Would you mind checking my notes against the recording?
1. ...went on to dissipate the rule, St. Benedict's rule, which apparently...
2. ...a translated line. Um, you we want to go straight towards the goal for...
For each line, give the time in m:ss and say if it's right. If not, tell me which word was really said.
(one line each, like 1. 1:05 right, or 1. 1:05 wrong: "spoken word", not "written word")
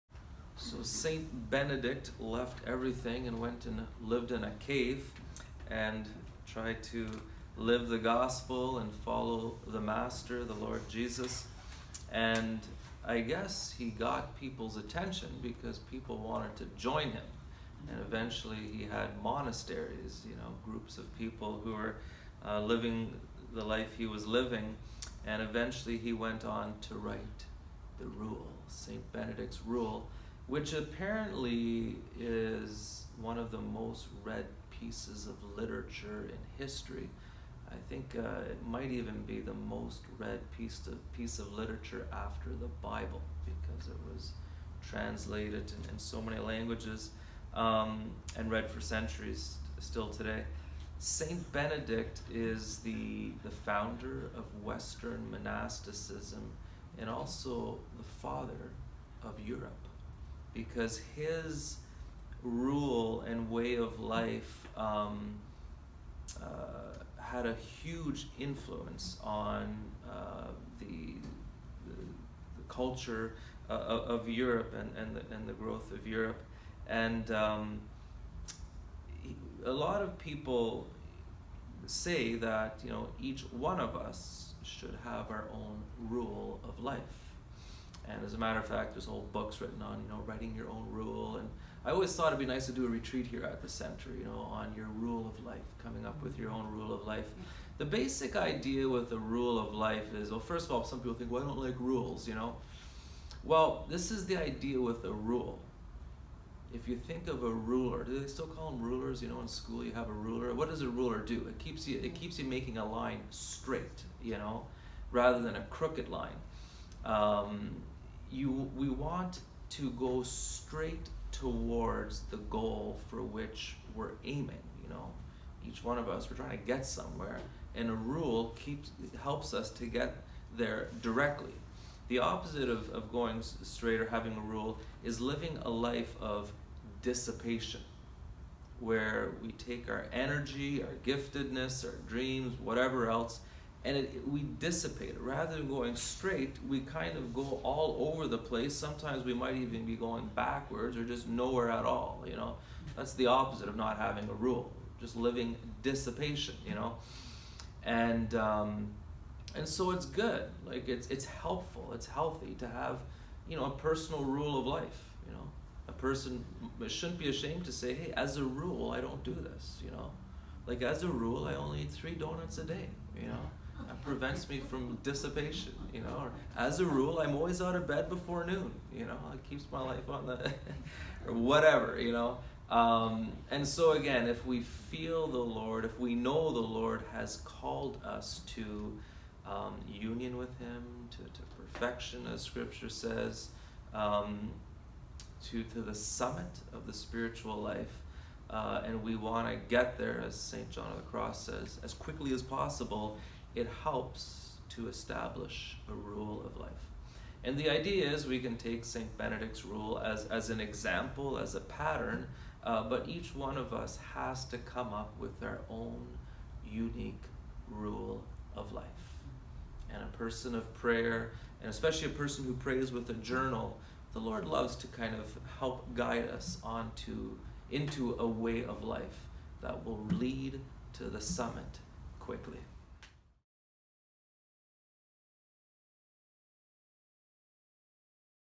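1. 0:26 wrong: "write", not "dissipate"
2. 1:55 wrong: "crooked", not "translated".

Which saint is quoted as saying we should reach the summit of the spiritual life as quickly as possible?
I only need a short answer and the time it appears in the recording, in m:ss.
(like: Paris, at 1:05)
St. John of the Cross, at 3:20.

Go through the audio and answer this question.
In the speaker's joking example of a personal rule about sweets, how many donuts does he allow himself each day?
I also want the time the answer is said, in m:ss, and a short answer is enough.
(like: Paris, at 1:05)
3, at 2:51.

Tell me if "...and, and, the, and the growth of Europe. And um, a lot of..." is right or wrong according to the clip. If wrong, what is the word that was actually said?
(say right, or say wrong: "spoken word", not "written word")
right.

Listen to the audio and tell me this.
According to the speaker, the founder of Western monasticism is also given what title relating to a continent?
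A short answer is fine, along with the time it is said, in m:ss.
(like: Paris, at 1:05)
father of Europe, at 0:58.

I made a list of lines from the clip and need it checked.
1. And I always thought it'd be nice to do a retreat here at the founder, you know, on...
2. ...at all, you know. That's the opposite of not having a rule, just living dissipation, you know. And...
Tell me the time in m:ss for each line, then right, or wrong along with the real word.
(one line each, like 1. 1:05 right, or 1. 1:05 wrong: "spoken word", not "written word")
1. 1:31 wrong: "center", not "founder"
2. 2:31 right.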